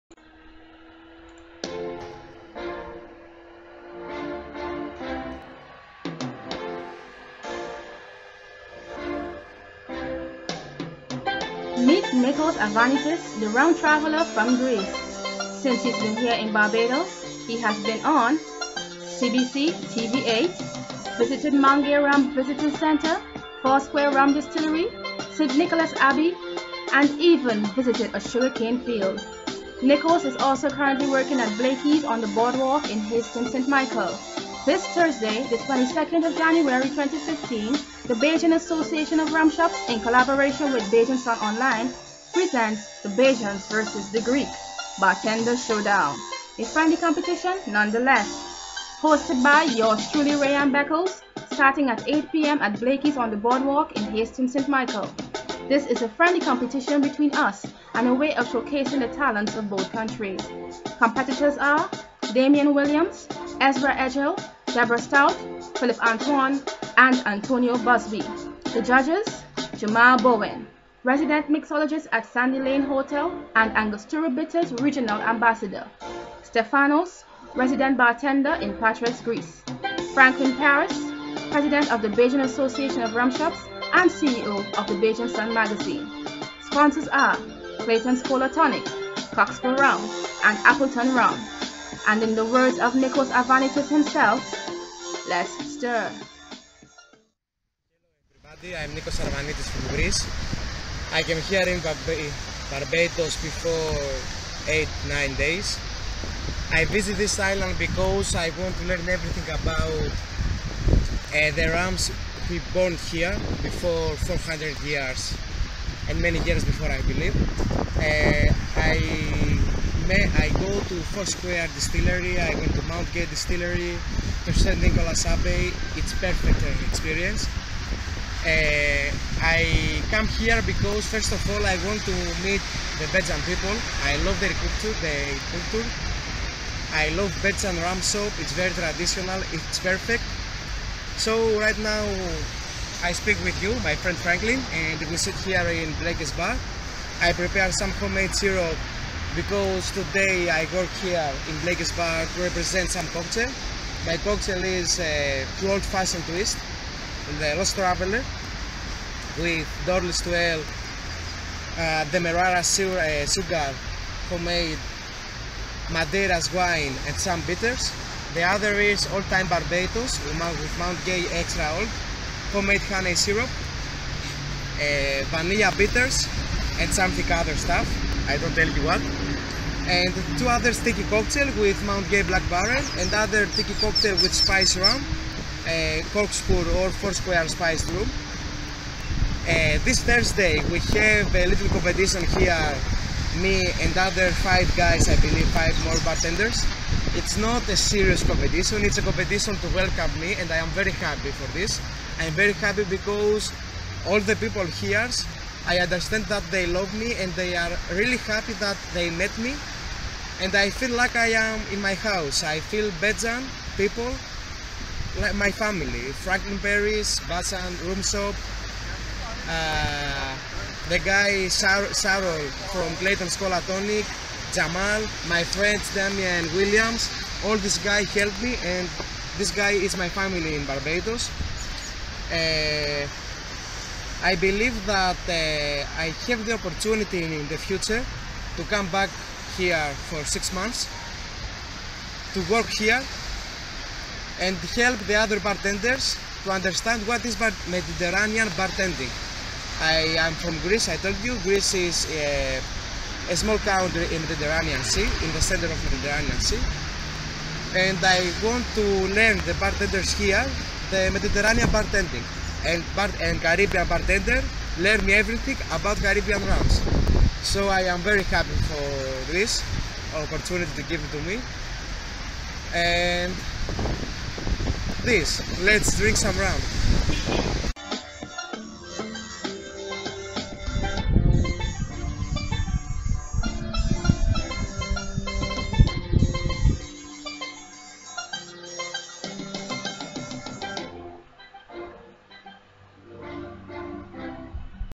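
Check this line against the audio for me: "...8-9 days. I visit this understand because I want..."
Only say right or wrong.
wrong.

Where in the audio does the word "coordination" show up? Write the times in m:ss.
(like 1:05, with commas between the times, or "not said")
not said.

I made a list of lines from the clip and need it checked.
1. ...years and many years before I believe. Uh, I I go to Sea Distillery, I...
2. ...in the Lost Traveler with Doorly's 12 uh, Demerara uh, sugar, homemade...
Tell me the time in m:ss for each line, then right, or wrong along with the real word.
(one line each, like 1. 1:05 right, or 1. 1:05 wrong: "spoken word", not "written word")
1. 1:54 wrong: "Square", not "Sea"
2. 2:37 right.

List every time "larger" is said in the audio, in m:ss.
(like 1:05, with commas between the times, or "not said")
not said.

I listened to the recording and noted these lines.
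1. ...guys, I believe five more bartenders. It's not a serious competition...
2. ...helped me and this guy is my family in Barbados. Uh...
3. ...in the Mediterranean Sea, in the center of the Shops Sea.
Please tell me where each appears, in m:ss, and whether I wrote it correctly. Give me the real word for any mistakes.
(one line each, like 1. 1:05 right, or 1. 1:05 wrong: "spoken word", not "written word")
1. 3:14 right
2. 3:48 right
3. 4:14 wrong: "Mediterranean", not "Shops".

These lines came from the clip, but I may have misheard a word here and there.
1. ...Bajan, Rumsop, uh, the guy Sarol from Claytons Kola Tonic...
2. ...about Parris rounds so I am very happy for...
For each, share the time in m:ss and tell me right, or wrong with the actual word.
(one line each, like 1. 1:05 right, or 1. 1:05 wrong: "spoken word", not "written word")
1. 3:37 right
2. 4:25 wrong: "Caribbean", not "Parris".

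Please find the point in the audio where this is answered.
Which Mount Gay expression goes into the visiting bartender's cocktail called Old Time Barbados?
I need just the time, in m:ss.
2:50.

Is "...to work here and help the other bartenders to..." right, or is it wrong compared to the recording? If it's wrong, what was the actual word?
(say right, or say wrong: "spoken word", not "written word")
right.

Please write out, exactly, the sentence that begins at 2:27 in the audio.
I prepare some homemade syrup because today I work here in Blake's bar to represent some cocktail.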